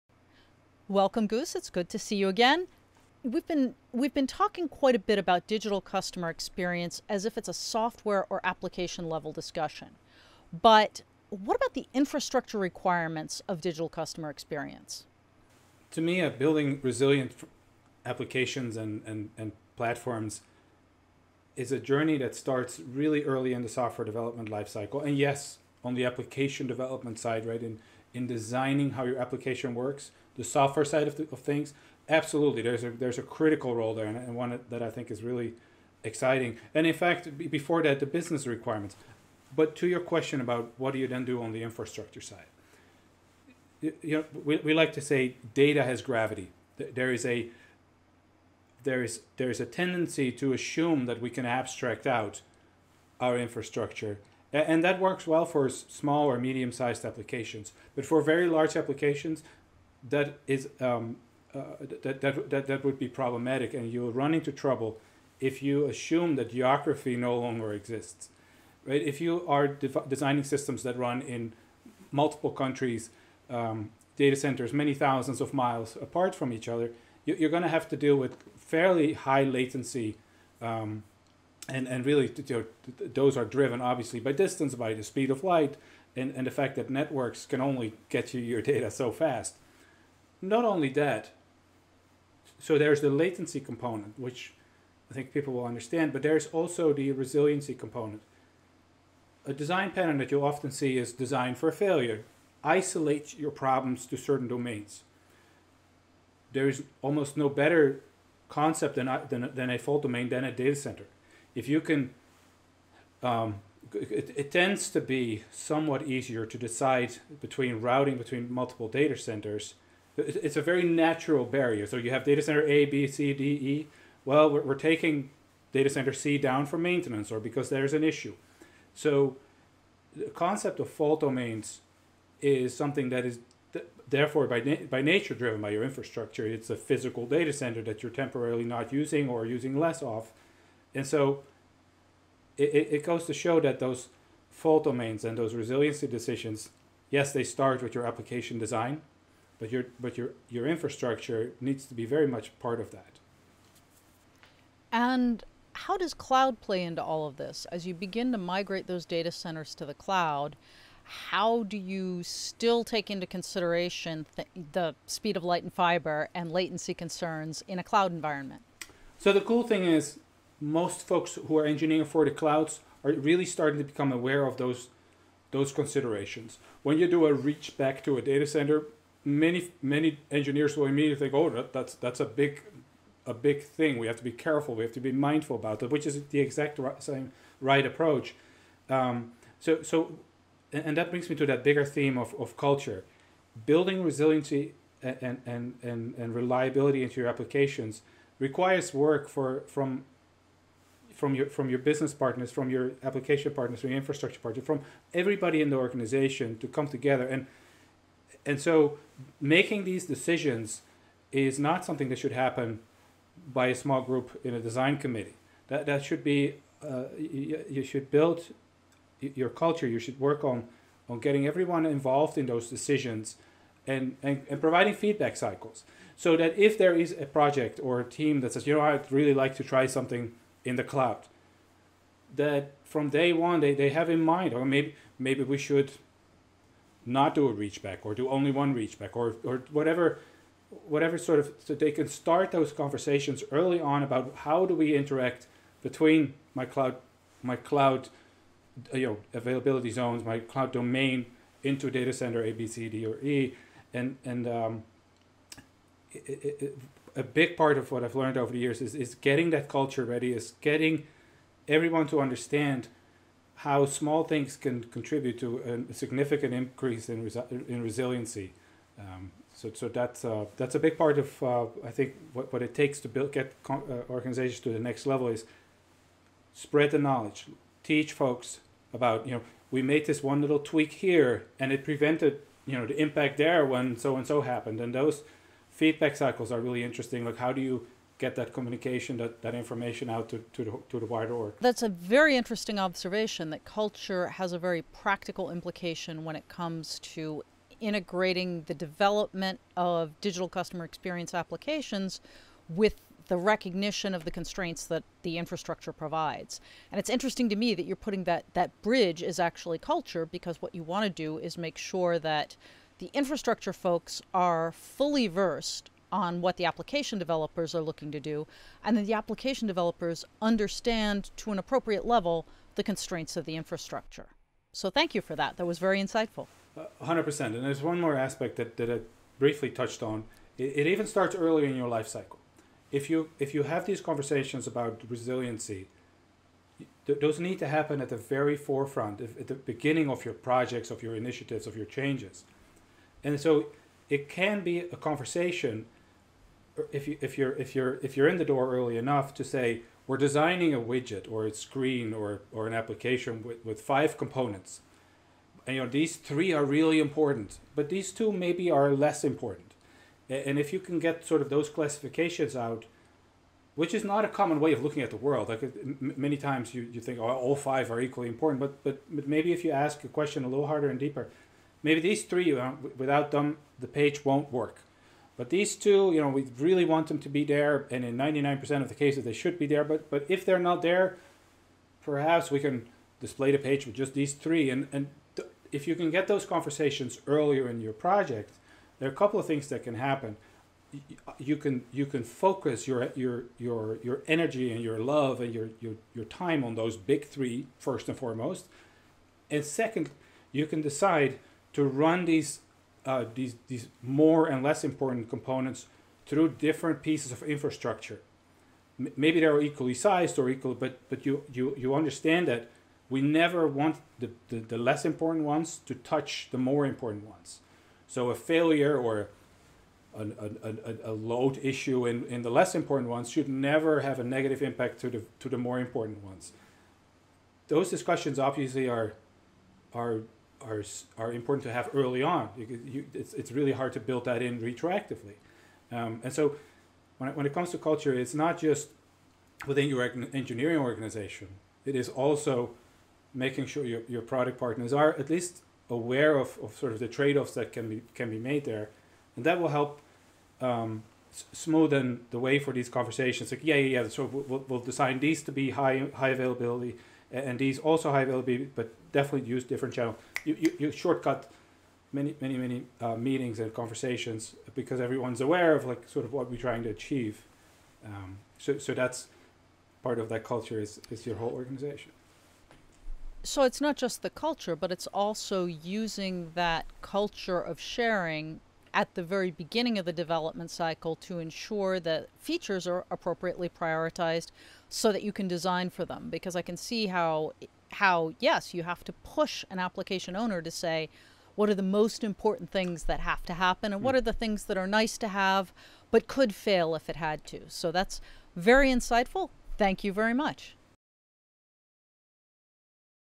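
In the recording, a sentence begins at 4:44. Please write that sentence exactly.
And those feedback cycles are really interesting.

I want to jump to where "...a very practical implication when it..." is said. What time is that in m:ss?
4:54.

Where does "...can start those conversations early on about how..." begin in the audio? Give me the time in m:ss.
4:01.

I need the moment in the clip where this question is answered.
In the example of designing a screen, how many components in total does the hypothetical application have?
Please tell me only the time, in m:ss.
5:53.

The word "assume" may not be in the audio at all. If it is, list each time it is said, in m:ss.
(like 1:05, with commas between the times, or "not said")
0:50, 1:05.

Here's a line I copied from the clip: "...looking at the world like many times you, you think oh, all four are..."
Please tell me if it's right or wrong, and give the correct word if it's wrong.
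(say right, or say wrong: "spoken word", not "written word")
wrong: "five", not "four".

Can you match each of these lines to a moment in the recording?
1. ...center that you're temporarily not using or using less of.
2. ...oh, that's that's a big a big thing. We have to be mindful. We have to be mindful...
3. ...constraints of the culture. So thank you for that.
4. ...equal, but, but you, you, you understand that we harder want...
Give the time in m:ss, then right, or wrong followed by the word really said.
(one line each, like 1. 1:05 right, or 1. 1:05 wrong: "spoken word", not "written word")
1. 2:17 right
2. 3:01 wrong: "careful", not "mindful"
3. 5:22 wrong: "infrastructure", not "culture"
4. 6:50 wrong: "never", not "harder".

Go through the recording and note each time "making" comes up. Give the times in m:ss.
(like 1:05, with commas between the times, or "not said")
3:29, 7:23.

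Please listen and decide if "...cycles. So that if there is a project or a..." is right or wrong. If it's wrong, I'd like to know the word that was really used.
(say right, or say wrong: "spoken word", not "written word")
right.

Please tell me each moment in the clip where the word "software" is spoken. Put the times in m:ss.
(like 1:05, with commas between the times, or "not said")
0:07, 0:23, 0:30.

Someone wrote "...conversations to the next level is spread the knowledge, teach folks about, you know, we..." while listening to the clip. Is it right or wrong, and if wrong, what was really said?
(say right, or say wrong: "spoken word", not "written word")
wrong: "organizations", not "conversations".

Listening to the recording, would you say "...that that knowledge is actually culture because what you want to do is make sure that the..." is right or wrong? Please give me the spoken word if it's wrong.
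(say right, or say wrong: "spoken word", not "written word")
wrong: "bridge", not "knowledge".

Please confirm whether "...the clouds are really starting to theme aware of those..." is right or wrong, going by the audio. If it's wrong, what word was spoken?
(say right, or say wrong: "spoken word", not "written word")
wrong: "become", not "theme".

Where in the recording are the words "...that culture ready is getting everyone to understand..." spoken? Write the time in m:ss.
4:19.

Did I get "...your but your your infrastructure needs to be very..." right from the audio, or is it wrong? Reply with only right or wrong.
right.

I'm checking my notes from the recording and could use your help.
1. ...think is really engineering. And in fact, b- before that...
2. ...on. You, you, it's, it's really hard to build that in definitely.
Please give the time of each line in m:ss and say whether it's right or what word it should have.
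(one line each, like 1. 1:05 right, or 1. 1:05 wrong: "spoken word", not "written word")
1. 0:34 wrong: "exciting", not "engineering"
2. 7:12 wrong: "retroactively", not "definitely".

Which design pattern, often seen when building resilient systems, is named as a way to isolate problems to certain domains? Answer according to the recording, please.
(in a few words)
Design for failure.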